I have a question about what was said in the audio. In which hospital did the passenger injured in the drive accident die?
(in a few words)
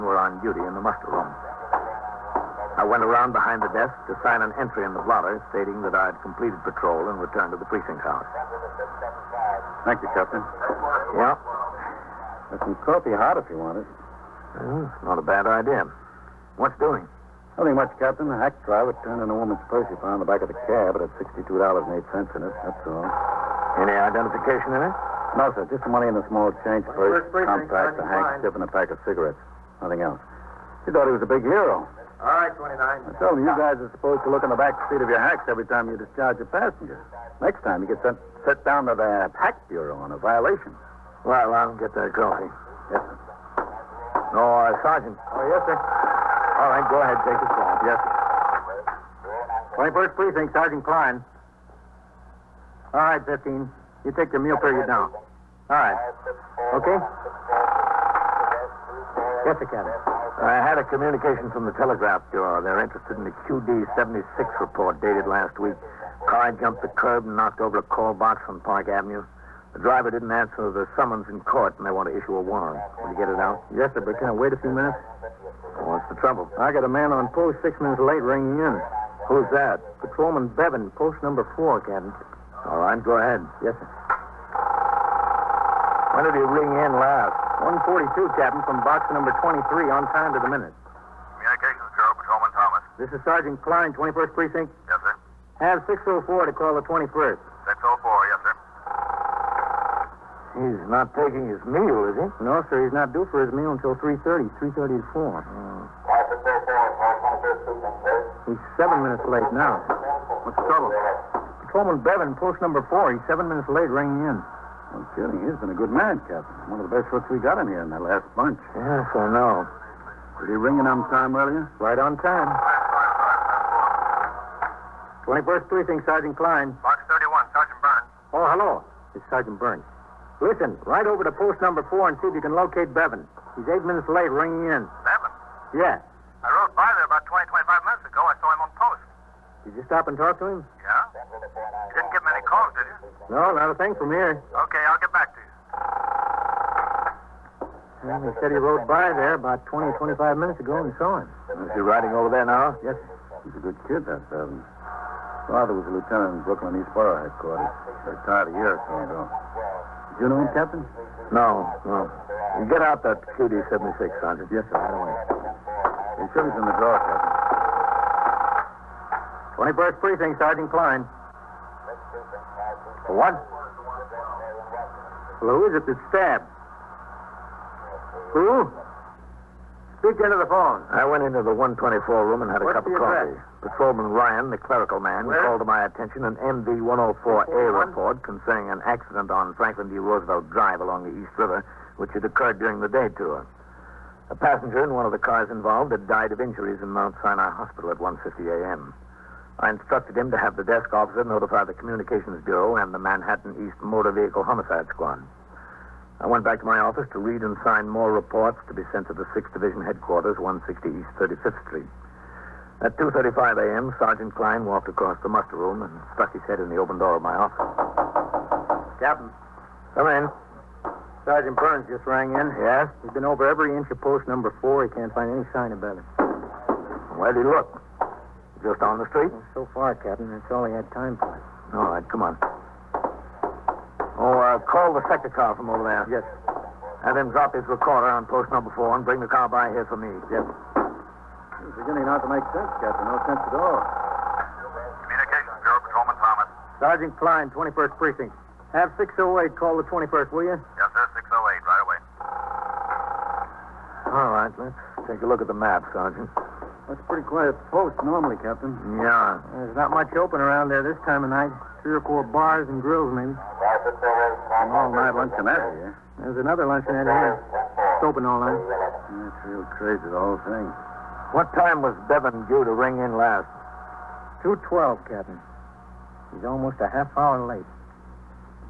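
Mount Sinai Hospital.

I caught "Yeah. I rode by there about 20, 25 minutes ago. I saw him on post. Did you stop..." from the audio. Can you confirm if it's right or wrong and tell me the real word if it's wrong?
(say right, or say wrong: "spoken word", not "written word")
right.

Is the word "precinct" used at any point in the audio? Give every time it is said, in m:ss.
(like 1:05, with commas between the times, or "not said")
0:07, 0:50, 1:34, 2:05, 2:50, 4:07.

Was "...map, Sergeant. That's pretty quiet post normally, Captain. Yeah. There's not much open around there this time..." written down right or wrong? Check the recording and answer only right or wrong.
right.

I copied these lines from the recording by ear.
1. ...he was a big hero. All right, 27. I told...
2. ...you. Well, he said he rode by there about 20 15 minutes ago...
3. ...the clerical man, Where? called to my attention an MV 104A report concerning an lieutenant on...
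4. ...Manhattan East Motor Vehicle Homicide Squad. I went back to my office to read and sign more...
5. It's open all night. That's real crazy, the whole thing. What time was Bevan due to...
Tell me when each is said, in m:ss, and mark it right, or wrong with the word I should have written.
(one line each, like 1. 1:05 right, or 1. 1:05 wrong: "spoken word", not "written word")
1. 0:31 wrong: "29", not "27"
2. 2:25 wrong: "25", not "15"
3. 3:04 wrong: "accident", not "lieutenant"
4. 3:23 right
5. 4:27 right.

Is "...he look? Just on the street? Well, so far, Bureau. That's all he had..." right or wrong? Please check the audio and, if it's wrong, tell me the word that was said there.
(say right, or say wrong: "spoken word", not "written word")
wrong: "Captain", not "Bureau".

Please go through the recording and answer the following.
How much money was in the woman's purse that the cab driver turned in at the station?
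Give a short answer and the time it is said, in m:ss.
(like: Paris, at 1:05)
$62.08, at 0:21.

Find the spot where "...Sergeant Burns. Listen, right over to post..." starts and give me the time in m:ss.
2:09.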